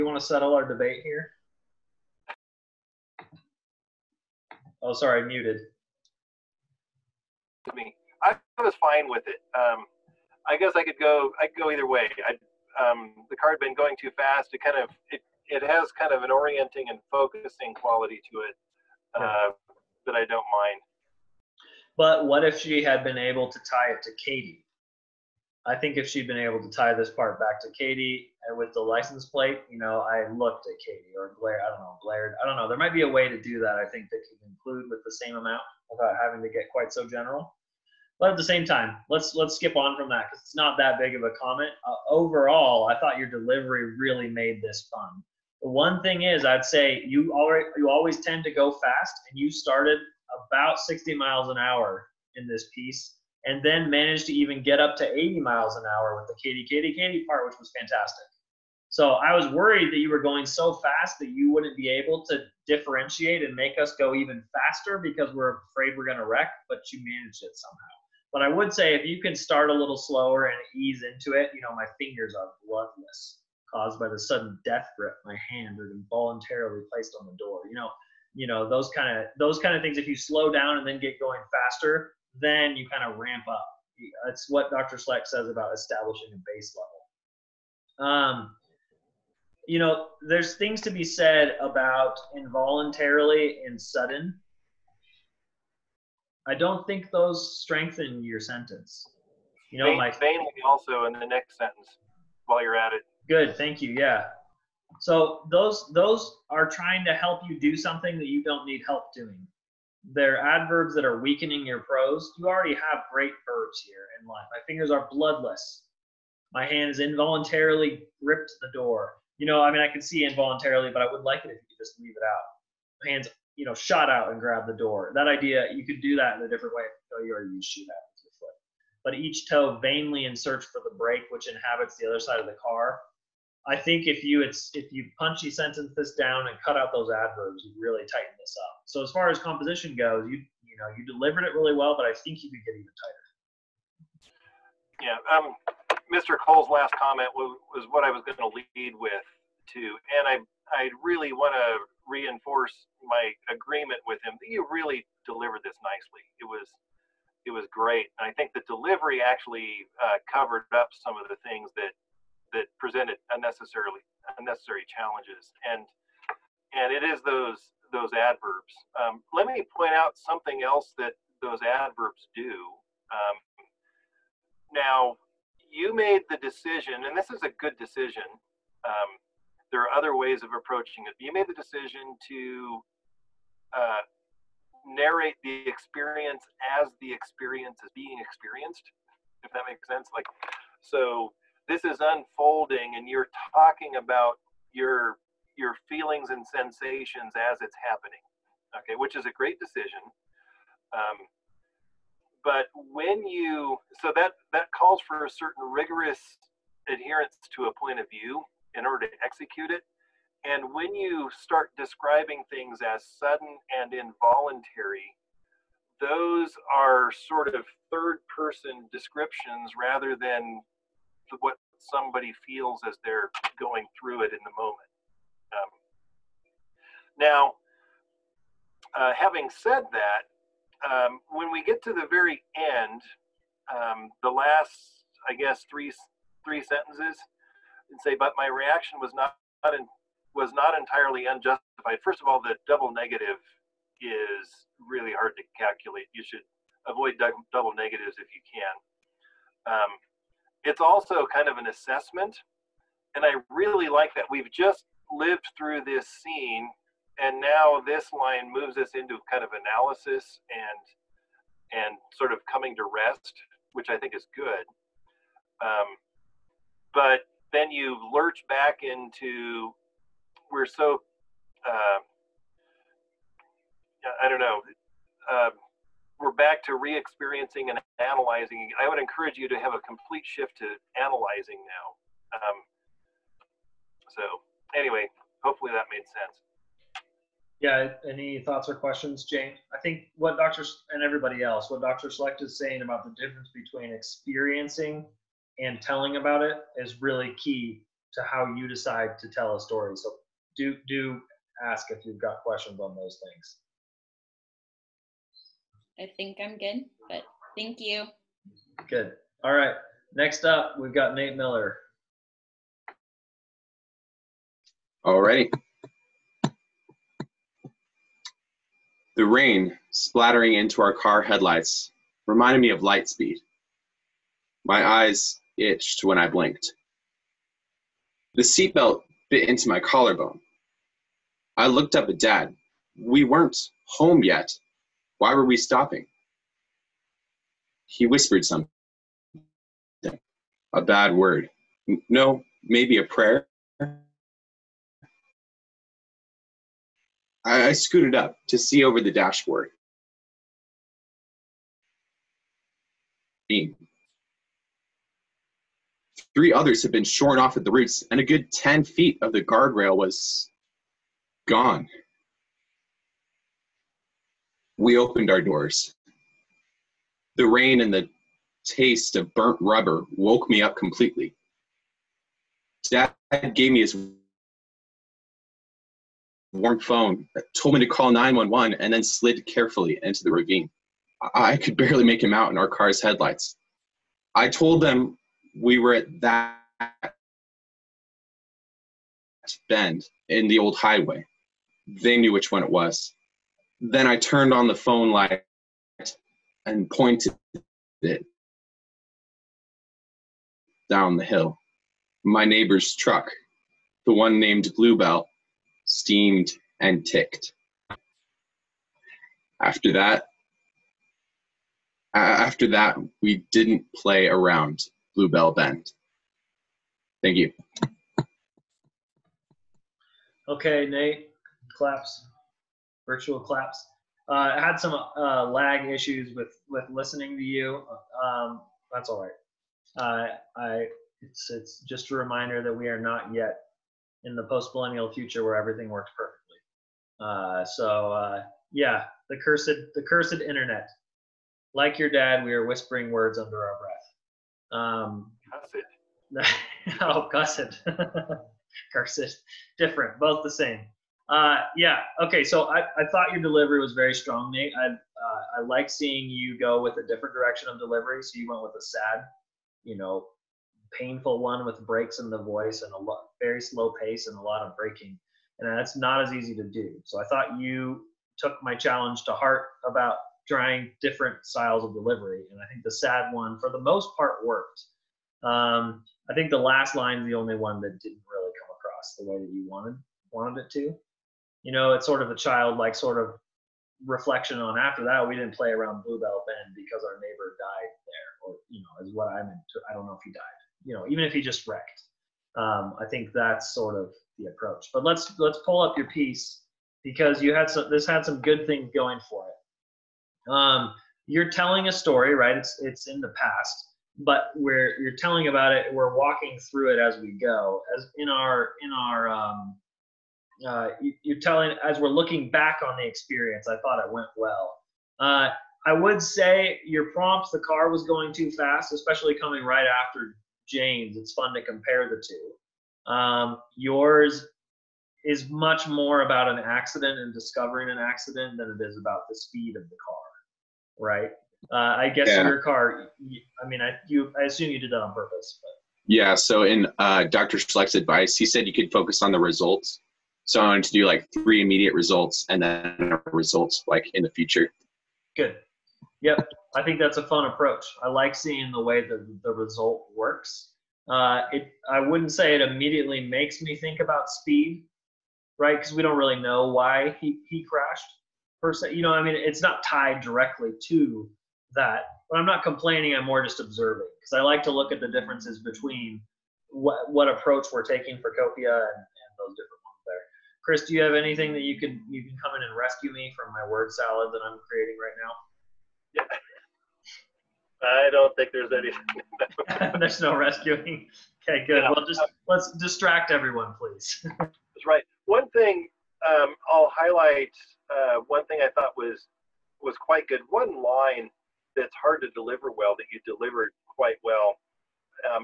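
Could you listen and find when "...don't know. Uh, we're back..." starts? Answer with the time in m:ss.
4:34.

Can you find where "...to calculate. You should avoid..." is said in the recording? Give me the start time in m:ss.
4:05.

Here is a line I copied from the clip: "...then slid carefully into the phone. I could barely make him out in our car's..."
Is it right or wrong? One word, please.
wrong.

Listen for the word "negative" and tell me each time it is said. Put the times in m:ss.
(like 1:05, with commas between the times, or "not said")
4:02, 4:07.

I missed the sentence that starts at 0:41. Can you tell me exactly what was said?
Uh, overall, I thought your delivery really made this fun.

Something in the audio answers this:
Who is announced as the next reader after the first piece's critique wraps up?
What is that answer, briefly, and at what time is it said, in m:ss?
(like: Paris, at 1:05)
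Nate Miller, at 5:11.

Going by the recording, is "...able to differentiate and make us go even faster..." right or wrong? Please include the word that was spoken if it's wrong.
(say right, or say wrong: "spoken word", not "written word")
right.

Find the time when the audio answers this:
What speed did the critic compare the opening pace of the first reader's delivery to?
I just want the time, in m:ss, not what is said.
0:50.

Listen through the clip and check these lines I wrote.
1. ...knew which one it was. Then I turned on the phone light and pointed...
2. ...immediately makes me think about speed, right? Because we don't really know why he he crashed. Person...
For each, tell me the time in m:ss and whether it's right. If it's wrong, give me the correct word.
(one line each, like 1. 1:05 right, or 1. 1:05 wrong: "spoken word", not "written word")
1. 6:32 right
2. 9:12 right.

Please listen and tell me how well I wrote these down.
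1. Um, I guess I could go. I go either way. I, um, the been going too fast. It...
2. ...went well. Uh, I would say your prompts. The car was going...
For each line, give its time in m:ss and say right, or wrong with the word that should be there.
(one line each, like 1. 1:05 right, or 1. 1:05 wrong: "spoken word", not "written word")
1. 0:09 right
2. 8:34 right.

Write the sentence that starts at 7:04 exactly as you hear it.
Uh, I had some uh, lag issues with with listening to you.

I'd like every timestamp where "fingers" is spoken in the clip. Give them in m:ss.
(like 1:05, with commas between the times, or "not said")
1:11, 1:54.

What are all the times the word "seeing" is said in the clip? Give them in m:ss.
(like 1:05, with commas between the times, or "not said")
7:35, 9:08.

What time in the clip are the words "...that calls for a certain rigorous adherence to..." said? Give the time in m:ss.
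3:24.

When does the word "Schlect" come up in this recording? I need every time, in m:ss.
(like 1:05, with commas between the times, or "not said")
1:24, 4:52, 8:57.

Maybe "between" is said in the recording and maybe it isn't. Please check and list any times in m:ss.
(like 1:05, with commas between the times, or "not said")
4:53, 9:25.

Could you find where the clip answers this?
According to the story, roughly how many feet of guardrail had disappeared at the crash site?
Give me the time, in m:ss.
5:58.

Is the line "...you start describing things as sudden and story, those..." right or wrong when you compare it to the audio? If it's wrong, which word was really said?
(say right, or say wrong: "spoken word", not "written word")
wrong: "involuntary", not "story".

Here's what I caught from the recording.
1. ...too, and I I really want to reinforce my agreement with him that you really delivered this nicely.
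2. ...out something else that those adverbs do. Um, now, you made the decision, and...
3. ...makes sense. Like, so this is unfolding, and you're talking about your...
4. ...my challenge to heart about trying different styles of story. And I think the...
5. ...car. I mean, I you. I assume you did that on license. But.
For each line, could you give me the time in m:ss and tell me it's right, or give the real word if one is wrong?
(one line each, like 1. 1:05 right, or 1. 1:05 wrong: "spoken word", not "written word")
1. 2:29 right
2. 2:49 right
3. 3:09 right
4. 7:48 wrong: "delivery", not "story"
5. 8:52 wrong: "purpose", not "license".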